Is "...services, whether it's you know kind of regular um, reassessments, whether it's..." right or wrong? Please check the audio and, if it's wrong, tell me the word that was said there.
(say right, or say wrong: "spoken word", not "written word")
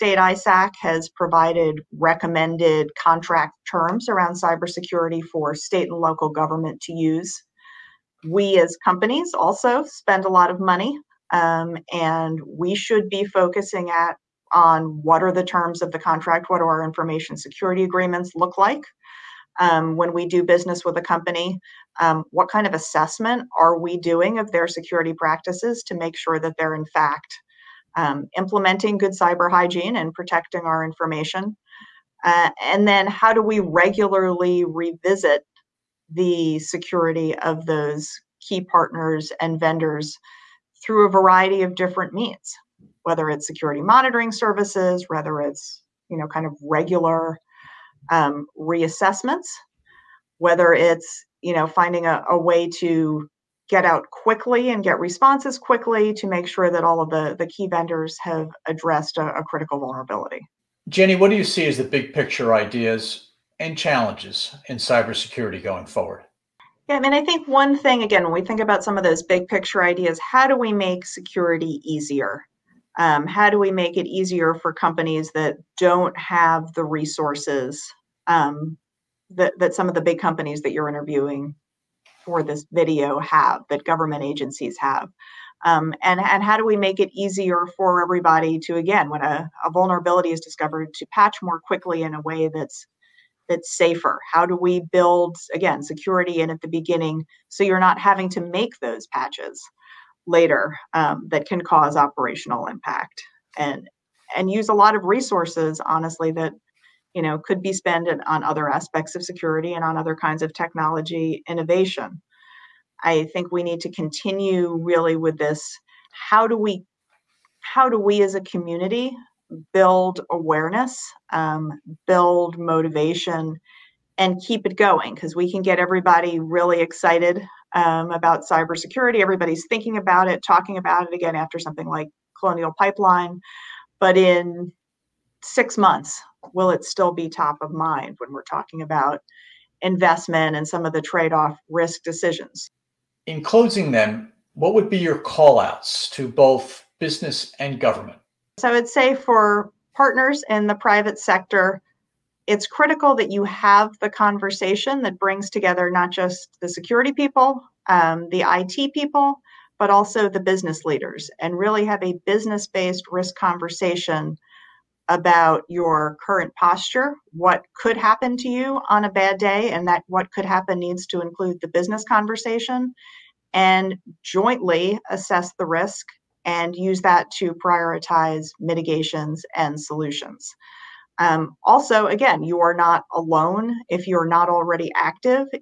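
right.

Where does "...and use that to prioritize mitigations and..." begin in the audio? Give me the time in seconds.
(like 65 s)
176 s.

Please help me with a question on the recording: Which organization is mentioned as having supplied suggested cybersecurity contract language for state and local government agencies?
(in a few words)
ISAC.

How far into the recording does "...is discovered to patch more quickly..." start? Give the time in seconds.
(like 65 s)
90 s.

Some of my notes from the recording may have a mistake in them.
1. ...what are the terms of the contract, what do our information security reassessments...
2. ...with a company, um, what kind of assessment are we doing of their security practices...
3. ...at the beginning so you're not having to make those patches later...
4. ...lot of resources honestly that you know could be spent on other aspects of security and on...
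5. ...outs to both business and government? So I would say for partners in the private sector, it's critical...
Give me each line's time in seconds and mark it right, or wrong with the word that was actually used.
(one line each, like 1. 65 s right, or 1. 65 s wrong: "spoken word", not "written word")
1. 15 s wrong: "agreements", not "reassessments"
2. 20 s right
3. 96 s right
4. 104 s right
5. 145 s right.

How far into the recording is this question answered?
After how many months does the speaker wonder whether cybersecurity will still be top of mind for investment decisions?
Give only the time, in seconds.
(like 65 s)
135 s.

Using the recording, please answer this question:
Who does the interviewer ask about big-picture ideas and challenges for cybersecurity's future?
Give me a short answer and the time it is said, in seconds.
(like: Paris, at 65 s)
Jenny, at 60 s.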